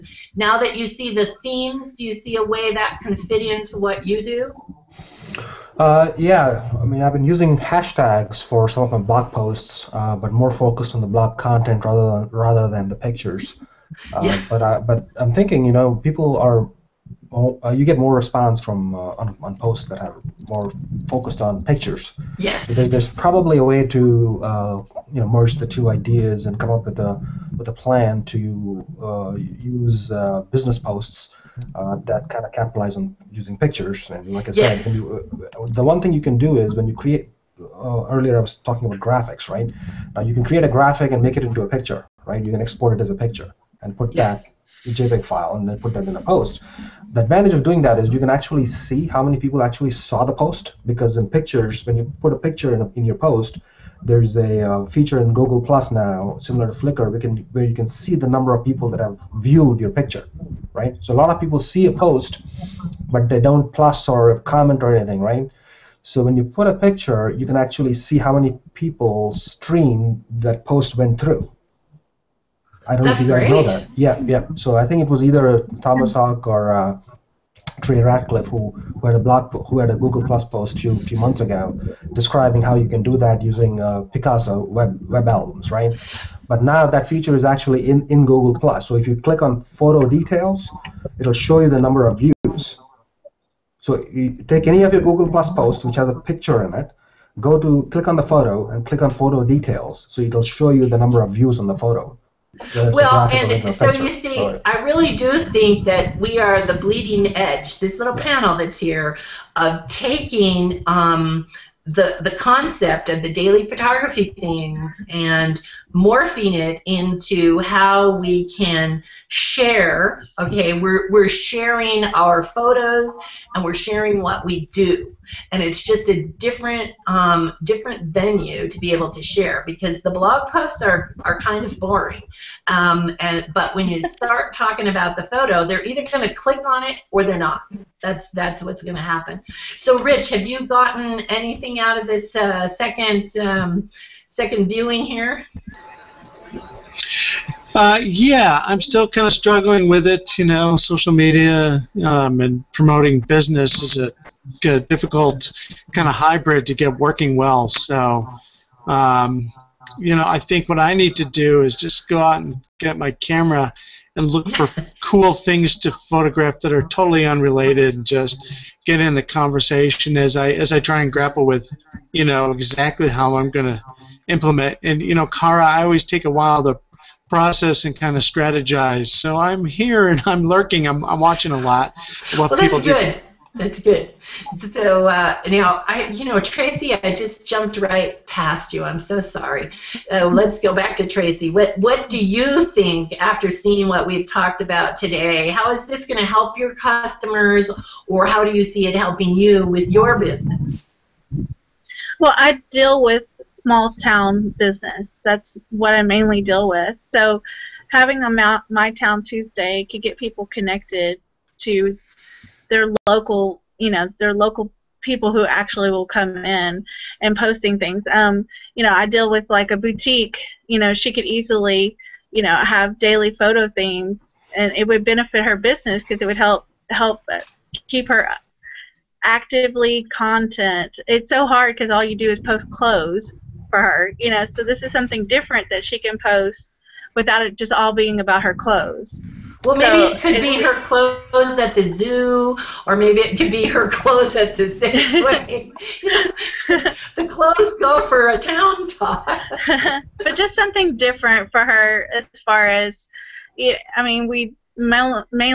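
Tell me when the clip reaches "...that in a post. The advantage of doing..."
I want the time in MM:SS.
00:45.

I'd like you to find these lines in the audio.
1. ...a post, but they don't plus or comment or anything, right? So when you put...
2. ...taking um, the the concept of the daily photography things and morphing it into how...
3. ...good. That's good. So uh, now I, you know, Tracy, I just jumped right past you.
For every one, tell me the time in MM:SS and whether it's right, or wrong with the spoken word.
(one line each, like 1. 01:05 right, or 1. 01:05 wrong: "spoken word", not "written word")
1. 01:01 right
2. 01:49 right
3. 03:03 right.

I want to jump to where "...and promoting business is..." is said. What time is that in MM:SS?
02:32.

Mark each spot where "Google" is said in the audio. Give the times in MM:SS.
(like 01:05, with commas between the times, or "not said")
00:55, 01:19, 01:28, 01:35.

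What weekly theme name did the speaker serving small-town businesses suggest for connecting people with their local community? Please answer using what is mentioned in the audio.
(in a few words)
Town Tuesday.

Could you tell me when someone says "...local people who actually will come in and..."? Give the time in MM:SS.
03:34.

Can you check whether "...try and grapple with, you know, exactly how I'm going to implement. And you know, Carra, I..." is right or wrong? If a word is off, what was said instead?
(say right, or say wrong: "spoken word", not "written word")
right.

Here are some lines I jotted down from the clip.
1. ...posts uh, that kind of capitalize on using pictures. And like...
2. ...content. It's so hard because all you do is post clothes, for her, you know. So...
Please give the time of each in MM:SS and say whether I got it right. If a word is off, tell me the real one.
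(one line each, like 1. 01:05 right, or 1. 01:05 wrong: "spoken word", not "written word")
1. 00:30 right
2. 03:50 right.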